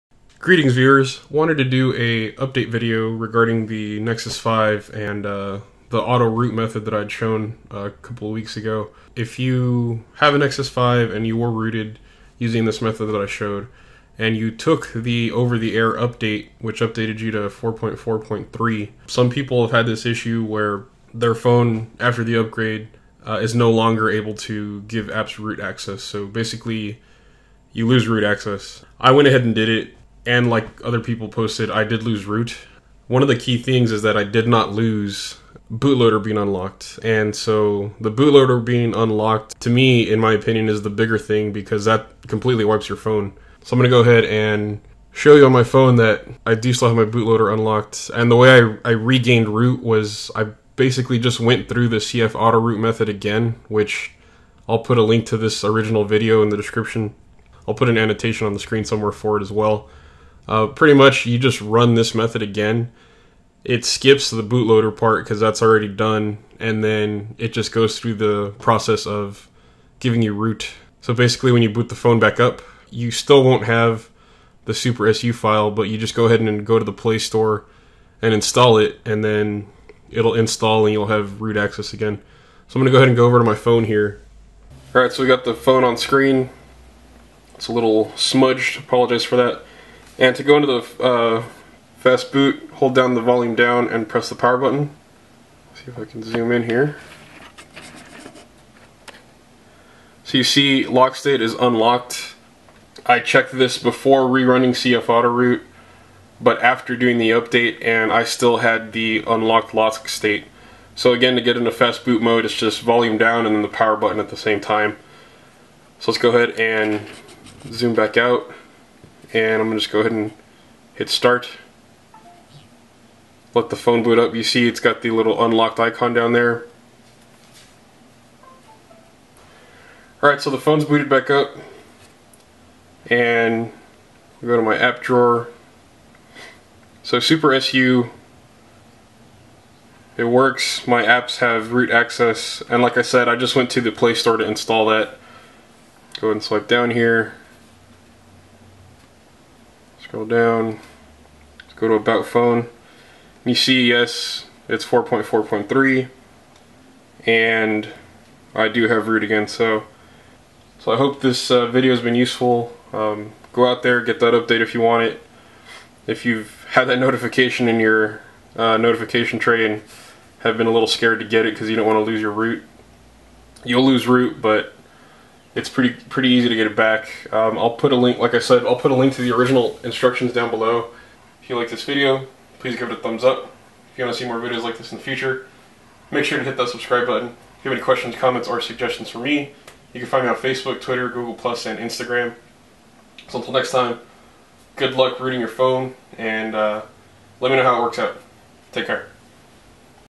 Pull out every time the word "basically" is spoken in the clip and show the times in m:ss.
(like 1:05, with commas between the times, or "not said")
0:26, 0:50, 1:11.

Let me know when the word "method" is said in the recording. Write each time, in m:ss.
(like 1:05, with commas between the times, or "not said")
0:06, 0:12, 0:52, 1:02.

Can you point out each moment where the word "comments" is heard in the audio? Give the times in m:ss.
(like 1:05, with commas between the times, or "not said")
3:08.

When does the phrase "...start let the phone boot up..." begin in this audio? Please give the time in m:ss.
2:01.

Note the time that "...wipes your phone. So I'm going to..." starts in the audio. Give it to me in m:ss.
0:42.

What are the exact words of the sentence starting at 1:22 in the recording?
So I'm gonna go ahead and go over to my phone here.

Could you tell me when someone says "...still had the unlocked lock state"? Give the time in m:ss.
1:48.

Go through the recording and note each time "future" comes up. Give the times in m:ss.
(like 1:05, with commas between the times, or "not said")
3:05.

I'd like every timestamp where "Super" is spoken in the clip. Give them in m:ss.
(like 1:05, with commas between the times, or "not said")
1:14, 2:17.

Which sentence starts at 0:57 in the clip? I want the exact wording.
I'll put an annotation on the screen somewhere for it as well.